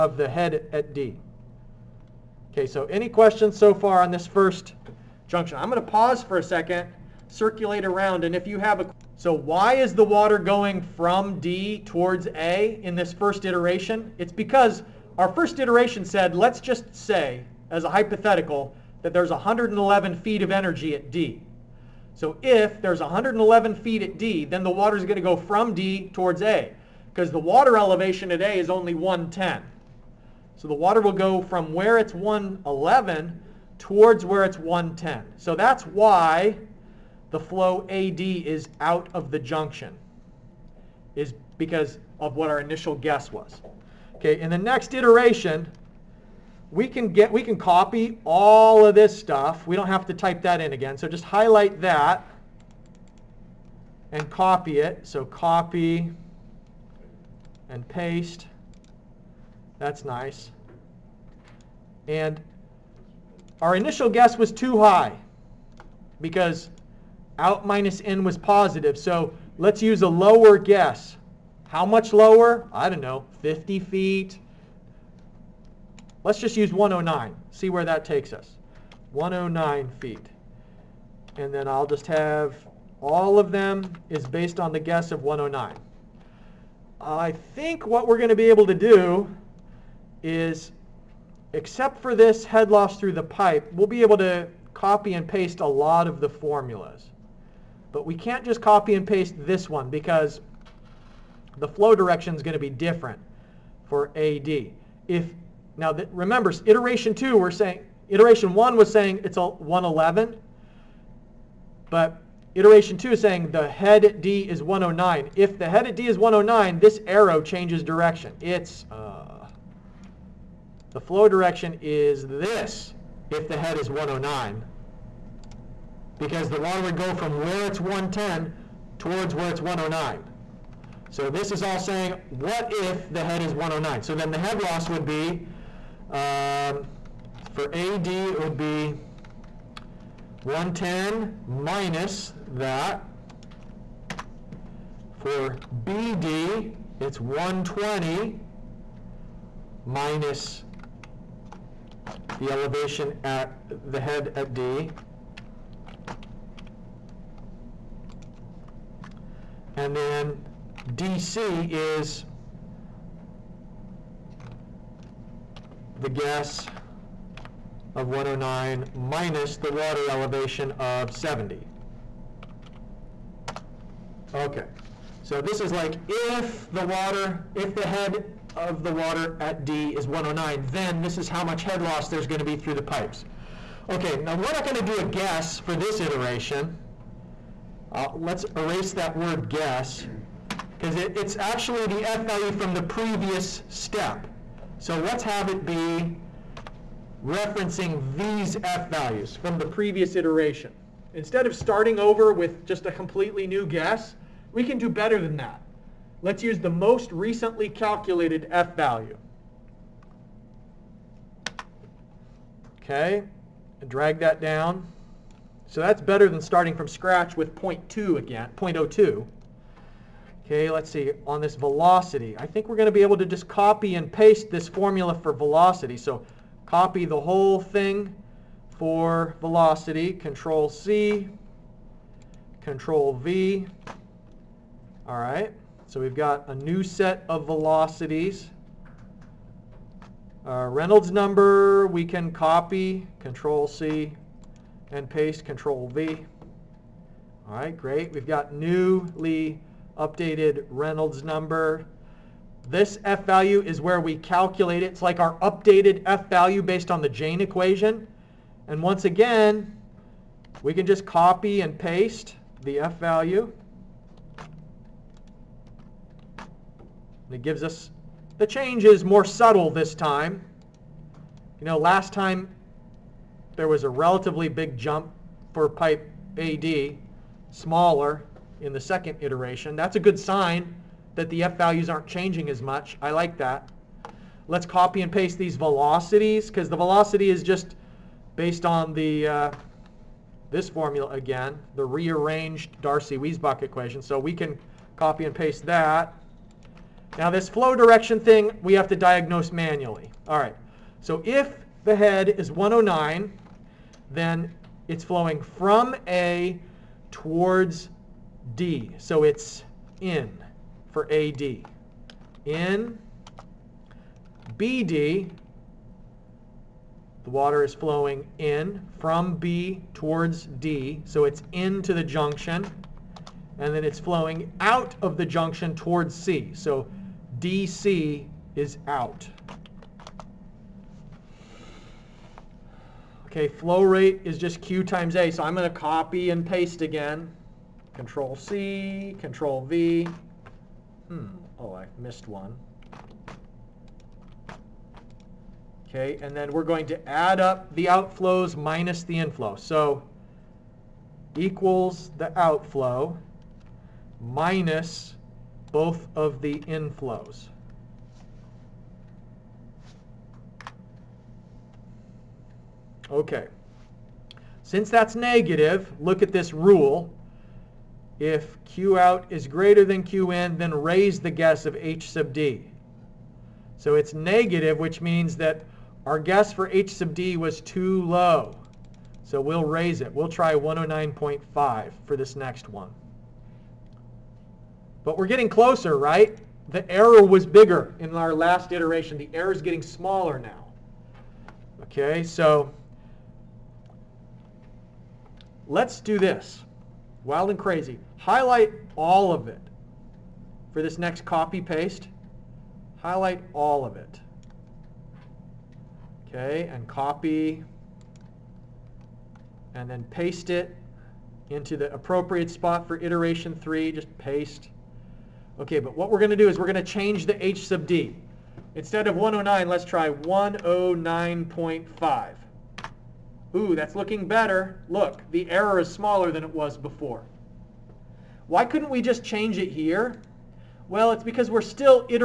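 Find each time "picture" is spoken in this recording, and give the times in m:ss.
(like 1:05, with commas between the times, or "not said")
not said.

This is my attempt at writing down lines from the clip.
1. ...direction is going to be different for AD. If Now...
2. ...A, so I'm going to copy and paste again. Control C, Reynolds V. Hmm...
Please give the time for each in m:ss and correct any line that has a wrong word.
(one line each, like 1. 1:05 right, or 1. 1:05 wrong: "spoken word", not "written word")
1. 1:41 right
2. 5:35 wrong: "Control", not "Reynolds".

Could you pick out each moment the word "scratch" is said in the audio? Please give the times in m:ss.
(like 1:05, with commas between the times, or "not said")
3:36.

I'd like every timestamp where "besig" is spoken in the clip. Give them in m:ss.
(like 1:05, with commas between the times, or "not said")
not said.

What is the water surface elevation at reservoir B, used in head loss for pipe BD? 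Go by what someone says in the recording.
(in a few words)
120.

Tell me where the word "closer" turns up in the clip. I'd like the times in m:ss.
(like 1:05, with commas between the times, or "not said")
6:25.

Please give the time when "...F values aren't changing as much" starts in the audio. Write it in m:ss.
4:41.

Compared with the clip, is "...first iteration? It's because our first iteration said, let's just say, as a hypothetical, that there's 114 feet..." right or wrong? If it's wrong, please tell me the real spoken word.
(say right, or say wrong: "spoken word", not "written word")
wrong: "111", not "114".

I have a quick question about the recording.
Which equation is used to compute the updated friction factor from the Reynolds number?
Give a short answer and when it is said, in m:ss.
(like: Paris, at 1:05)
Jain equation, at 4:17.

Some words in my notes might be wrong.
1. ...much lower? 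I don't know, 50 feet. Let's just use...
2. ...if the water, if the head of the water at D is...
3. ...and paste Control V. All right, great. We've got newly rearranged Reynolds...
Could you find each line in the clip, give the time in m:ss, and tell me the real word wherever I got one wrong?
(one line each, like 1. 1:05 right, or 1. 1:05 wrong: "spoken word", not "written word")
1. 1:11 right
2. 2:56 right
3. 4:04 wrong: "updated", not "rearranged".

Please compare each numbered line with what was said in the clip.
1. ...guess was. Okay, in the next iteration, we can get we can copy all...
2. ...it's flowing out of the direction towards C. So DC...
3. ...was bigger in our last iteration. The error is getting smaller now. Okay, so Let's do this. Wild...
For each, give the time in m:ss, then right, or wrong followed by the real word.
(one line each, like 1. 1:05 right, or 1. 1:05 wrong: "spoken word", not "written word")
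1. 0:42 right
2. 5:23 wrong: "junction", not "direction"
3. 6:27 right.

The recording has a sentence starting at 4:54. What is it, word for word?
So we can copy and paste that.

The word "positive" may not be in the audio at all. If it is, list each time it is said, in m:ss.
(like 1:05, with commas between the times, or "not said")
1:08.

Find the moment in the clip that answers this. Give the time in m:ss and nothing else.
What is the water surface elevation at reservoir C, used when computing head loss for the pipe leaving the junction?
2:51.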